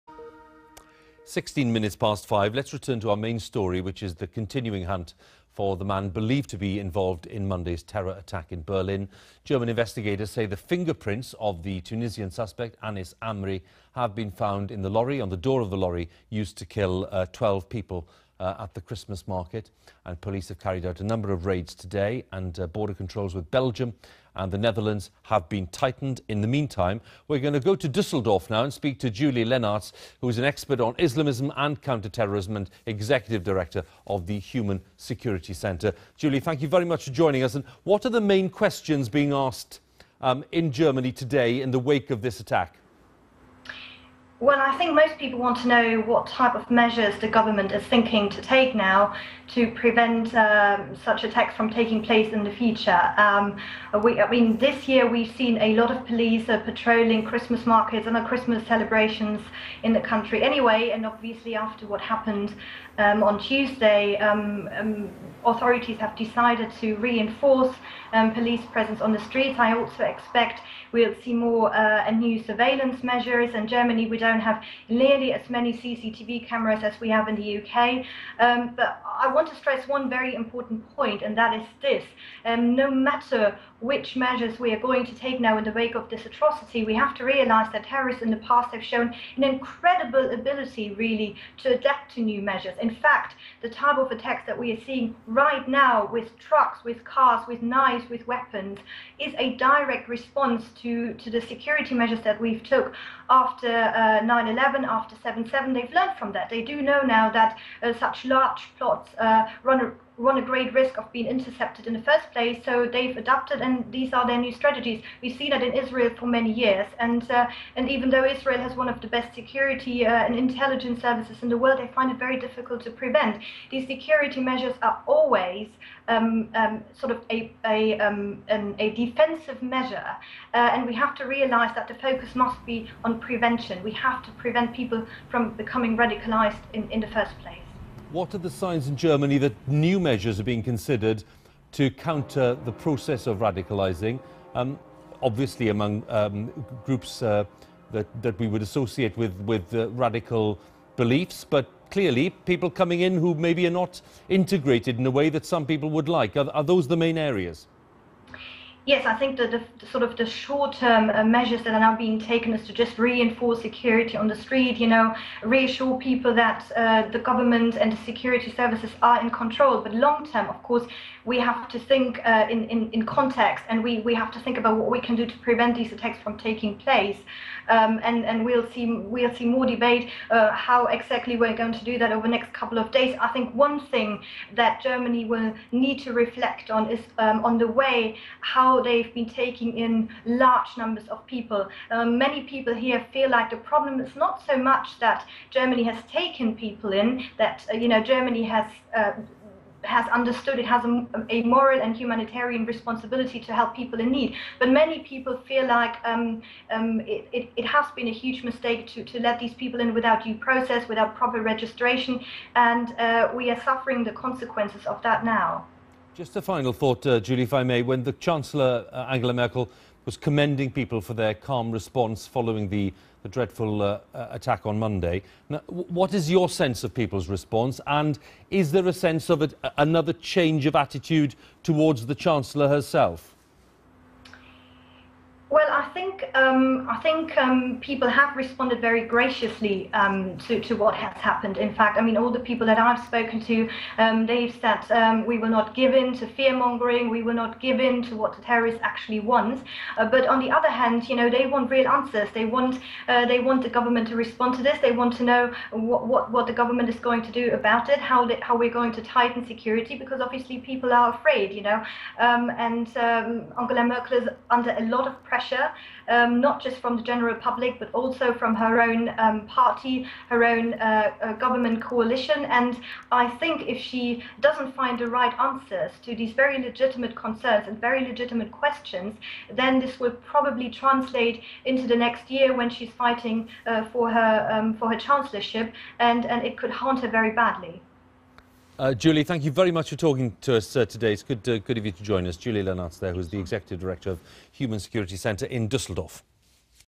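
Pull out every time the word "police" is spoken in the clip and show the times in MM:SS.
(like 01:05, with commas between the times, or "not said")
00:20, 00:56, 01:08.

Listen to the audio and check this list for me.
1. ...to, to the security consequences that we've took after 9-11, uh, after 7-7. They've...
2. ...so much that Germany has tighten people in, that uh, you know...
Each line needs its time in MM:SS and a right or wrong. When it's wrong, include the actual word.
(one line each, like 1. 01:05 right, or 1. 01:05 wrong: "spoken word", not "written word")
1. 01:40 wrong: "measures", not "consequences"
2. 03:14 wrong: "taken", not "tighten".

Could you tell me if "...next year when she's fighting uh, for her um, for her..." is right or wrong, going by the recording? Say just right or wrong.
right.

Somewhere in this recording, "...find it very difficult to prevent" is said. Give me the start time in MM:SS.
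02:01.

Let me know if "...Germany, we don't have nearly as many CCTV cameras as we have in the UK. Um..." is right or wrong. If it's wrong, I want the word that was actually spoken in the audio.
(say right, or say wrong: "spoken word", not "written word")
right.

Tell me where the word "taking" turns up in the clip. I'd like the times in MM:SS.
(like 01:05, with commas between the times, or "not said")
00:51, 02:56, 03:09.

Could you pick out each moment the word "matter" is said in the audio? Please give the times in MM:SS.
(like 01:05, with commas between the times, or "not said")
01:22.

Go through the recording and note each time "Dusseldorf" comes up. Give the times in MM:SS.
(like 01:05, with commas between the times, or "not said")
00:27, 04:55.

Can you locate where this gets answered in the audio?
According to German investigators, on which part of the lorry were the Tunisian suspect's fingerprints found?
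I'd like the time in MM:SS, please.
00:15.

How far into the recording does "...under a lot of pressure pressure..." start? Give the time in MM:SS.
04:24.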